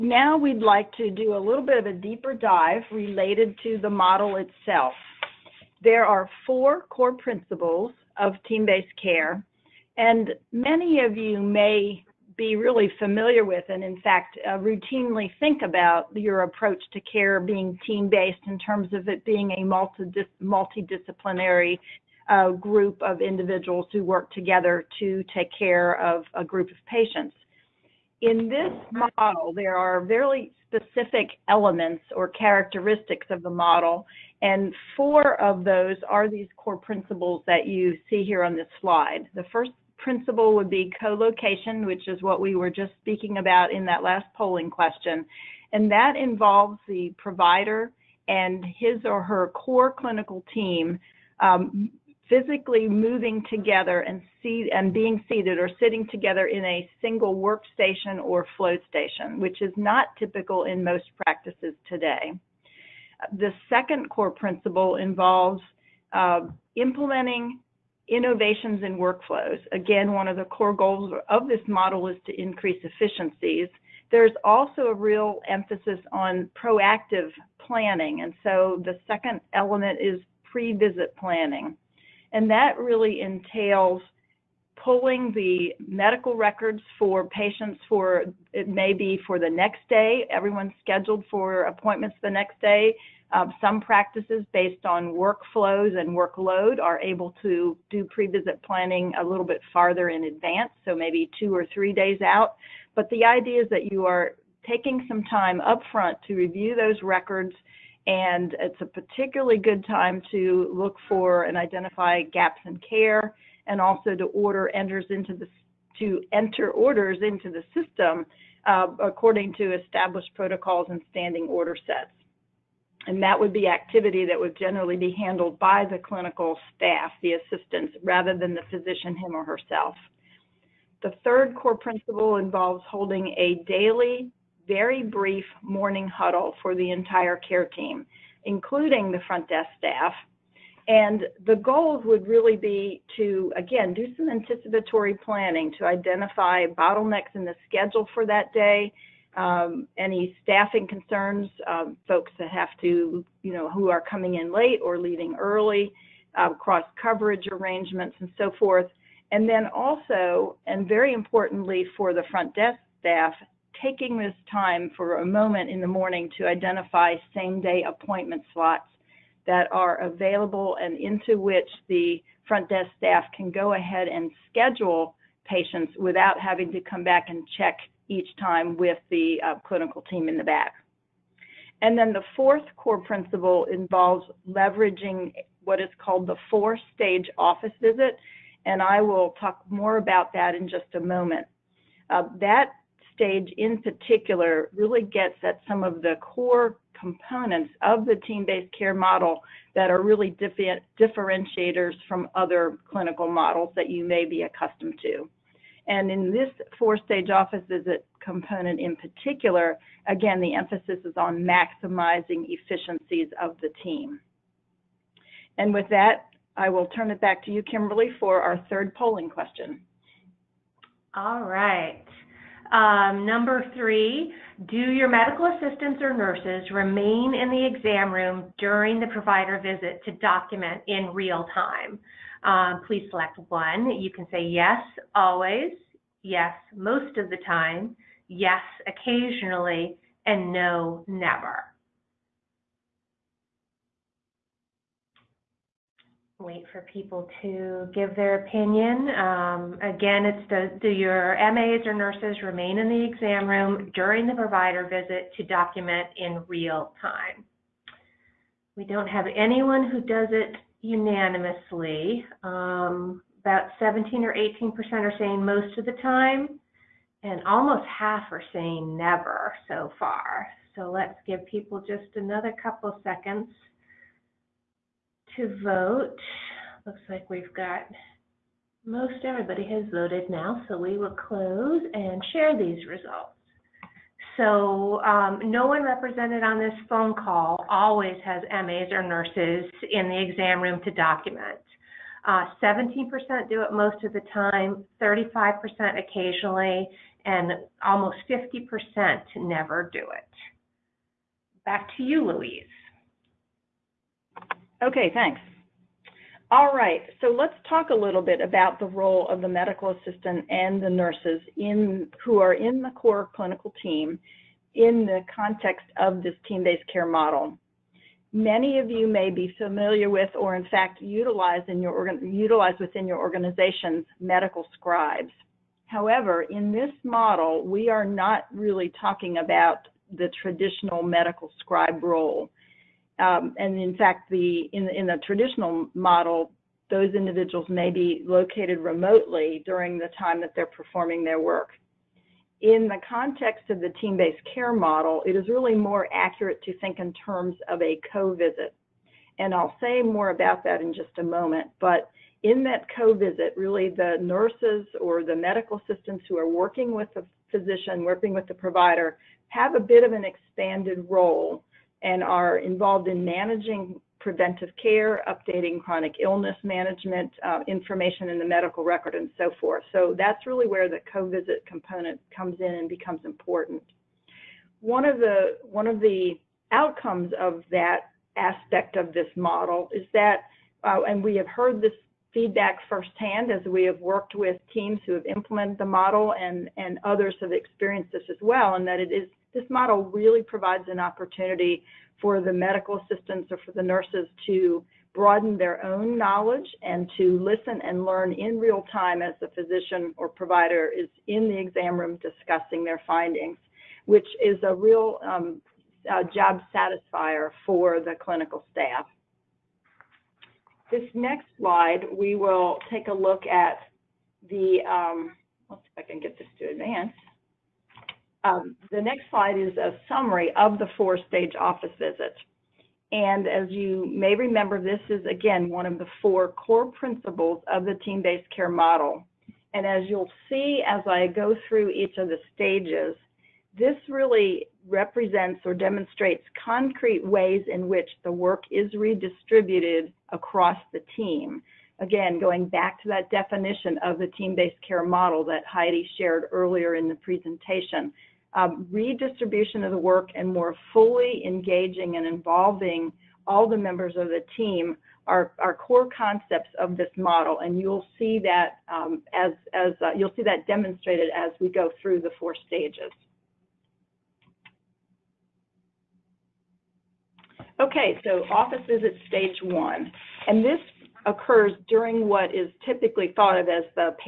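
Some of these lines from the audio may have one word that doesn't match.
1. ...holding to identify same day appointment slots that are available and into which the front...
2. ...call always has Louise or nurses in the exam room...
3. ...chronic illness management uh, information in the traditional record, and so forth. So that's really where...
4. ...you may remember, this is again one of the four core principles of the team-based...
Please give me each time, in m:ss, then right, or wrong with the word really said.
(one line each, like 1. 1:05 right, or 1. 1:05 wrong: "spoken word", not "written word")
1. 2:45 wrong: "morning", not "holding"
2. 4:47 wrong: "MAs", not "Louise"
3. 6:05 wrong: "medical", not "traditional"
4. 7:03 right.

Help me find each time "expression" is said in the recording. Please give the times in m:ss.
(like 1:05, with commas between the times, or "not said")
not said.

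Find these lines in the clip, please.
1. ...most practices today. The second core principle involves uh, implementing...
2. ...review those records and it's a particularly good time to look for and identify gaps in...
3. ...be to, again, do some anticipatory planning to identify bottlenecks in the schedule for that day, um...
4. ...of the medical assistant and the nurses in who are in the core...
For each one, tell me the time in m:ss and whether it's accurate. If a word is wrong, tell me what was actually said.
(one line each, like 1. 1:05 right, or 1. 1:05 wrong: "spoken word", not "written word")
1. 1:00 right
2. 1:46 right
3. 2:22 right
4. 5:09 right.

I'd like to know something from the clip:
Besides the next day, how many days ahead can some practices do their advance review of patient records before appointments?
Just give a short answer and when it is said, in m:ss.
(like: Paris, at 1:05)
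2 or 3 days, at 1:41.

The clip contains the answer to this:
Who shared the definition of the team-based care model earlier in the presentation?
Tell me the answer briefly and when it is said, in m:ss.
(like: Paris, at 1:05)
Heidi, at 7:25.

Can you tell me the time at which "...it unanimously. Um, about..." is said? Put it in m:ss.
4:20.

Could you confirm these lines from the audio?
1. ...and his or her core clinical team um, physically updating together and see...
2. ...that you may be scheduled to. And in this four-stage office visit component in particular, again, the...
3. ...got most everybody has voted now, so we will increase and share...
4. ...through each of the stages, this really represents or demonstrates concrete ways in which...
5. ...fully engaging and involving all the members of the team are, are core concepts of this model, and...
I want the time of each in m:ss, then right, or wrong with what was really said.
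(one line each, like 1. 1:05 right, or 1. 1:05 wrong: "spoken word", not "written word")
1. 0:48 wrong: "moving", not "updating"
2. 3:23 wrong: "accustomed", not "scheduled"
3. 4:37 wrong: "close", not "increase"
4. 7:11 right
5. 7:30 right.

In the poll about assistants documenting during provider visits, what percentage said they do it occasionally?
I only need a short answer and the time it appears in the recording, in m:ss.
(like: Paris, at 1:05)
35%, at 4:55.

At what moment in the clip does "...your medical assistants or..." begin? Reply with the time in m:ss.
3:44.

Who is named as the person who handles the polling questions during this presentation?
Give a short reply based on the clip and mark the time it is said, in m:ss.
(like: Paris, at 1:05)
Kimberly, at 3:37.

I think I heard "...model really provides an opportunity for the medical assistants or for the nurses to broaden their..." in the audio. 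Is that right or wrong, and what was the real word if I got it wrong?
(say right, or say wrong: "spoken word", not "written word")
right.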